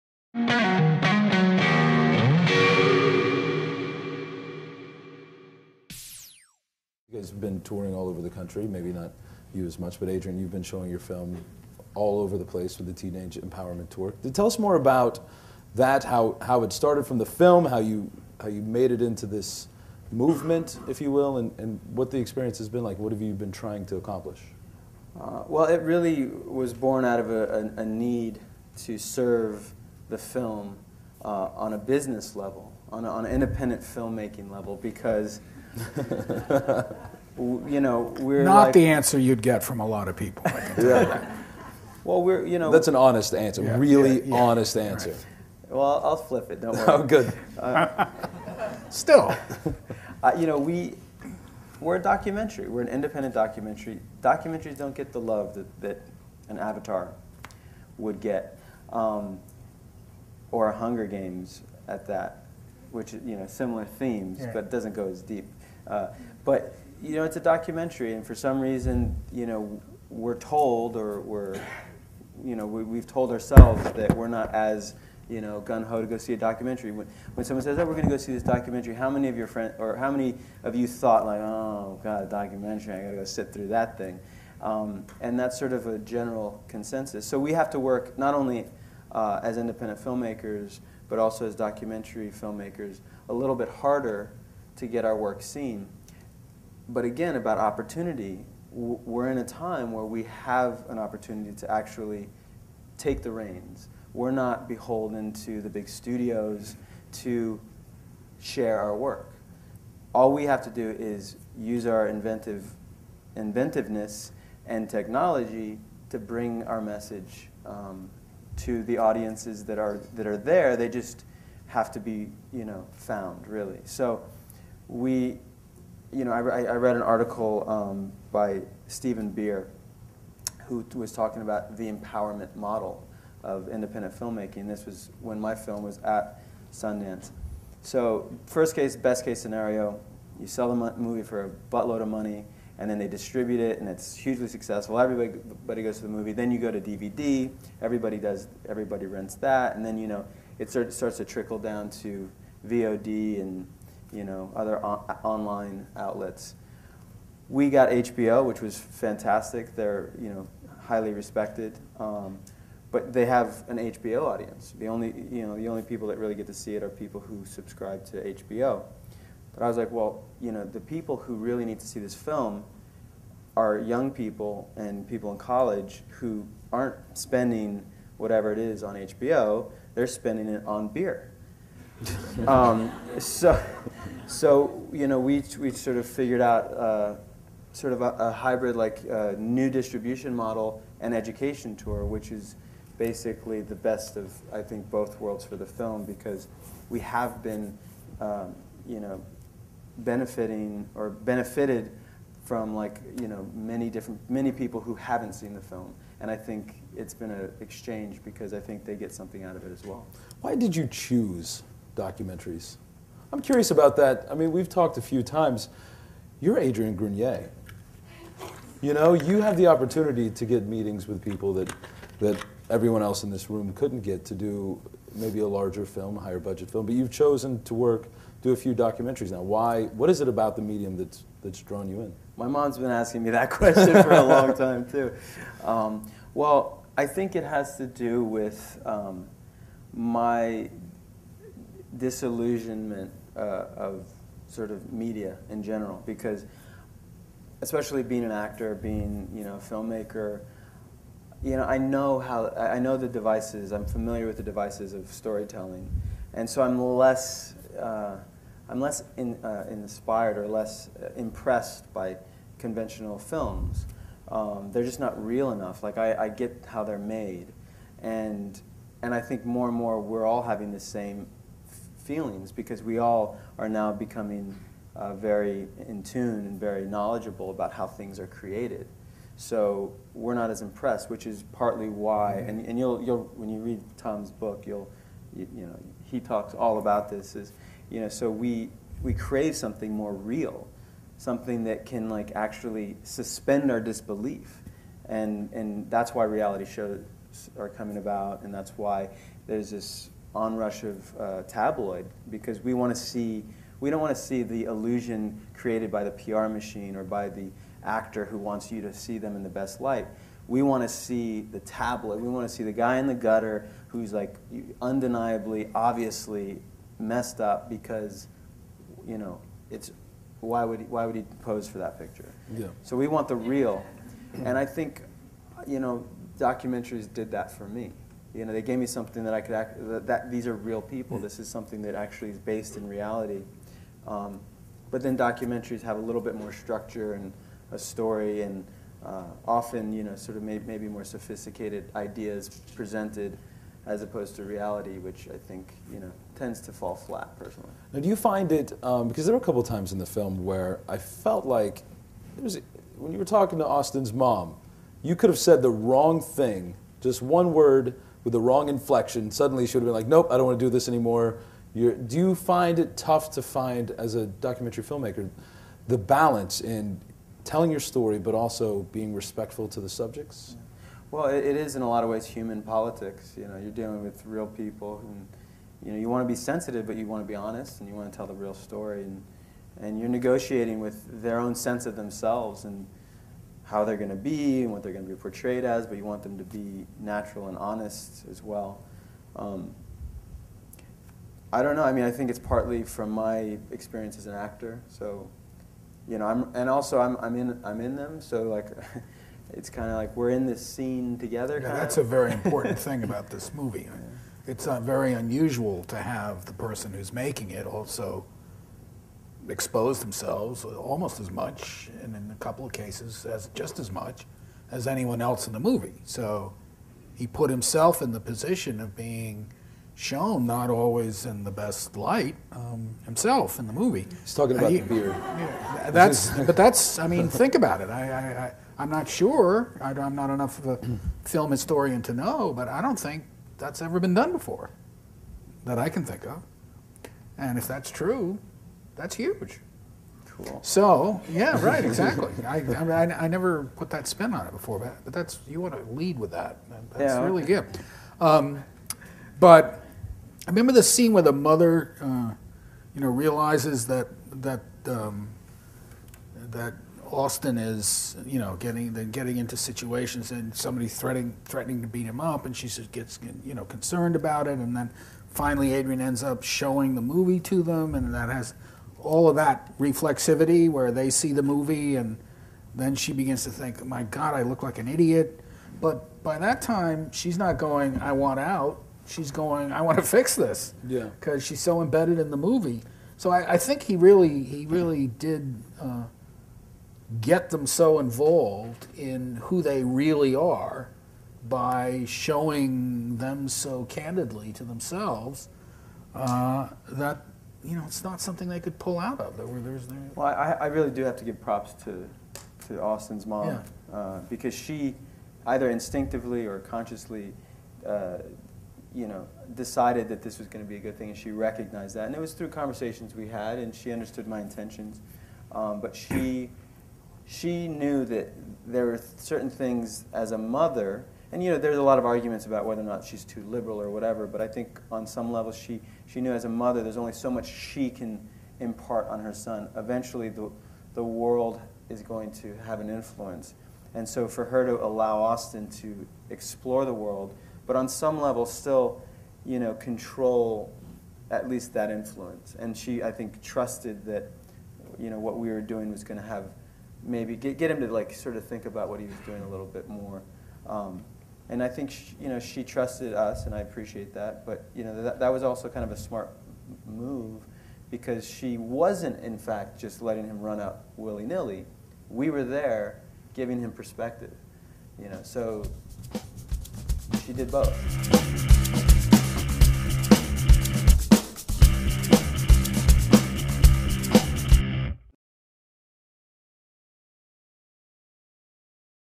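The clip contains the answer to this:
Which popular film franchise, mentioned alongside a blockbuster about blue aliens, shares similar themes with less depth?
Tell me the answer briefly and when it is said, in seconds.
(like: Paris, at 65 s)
Hunger Games, at 60 s.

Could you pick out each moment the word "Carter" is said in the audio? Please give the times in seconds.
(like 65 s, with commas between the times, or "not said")
not said.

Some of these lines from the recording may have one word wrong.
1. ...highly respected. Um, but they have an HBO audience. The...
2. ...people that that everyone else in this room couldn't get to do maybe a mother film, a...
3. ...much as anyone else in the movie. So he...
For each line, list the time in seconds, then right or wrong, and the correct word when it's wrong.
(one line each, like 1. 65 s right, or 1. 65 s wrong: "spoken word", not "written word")
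1. 160 s right
2. 221 s wrong: "larger", not "mother"
3. 413 s right.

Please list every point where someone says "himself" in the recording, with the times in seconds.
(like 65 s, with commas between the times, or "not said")
417 s, 423 s.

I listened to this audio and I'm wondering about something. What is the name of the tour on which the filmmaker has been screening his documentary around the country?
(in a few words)
Teenage Empowerment Tour.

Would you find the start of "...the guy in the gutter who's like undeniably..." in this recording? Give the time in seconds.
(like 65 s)
312 s.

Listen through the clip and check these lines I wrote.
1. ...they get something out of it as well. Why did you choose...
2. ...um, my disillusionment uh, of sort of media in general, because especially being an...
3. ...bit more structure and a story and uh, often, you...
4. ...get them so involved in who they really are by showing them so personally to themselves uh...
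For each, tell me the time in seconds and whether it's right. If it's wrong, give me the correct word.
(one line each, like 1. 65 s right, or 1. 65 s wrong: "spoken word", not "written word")
1. 208 s right
2. 238 s right
3. 336 s right
4. 487 s wrong: "candidly", not "personally".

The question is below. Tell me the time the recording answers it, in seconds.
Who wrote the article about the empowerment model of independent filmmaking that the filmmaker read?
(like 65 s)
128 s.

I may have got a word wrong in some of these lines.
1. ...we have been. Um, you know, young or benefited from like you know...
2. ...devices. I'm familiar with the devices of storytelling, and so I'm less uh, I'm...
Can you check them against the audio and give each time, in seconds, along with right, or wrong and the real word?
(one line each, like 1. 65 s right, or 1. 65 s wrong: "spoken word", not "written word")
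1. 196 s wrong: "benefiting", not "young"
2. 253 s right.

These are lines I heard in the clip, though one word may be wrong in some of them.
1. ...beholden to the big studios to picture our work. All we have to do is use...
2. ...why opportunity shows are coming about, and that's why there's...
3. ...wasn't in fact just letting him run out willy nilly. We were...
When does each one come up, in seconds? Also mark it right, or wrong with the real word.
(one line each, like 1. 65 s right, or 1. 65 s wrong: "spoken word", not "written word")
1. 104 s wrong: "share", not "picture"
2. 296 s wrong: "reality", not "opportunity"
3. 558 s right.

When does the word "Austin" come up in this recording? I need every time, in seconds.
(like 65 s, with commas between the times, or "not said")
353 s, 457 s, 502 s, 535 s.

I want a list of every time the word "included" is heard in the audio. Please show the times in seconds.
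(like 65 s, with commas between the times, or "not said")
not said.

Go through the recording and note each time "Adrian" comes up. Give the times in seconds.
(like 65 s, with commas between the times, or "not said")
10 s, 216 s, 465 s.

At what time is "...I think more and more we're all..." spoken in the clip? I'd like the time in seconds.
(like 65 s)
269 s.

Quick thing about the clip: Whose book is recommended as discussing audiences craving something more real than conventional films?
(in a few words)
Tom.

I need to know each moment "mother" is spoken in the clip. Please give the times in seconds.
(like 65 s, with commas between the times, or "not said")
451 s, 520 s, 526 s.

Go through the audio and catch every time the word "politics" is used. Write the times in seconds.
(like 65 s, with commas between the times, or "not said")
372 s.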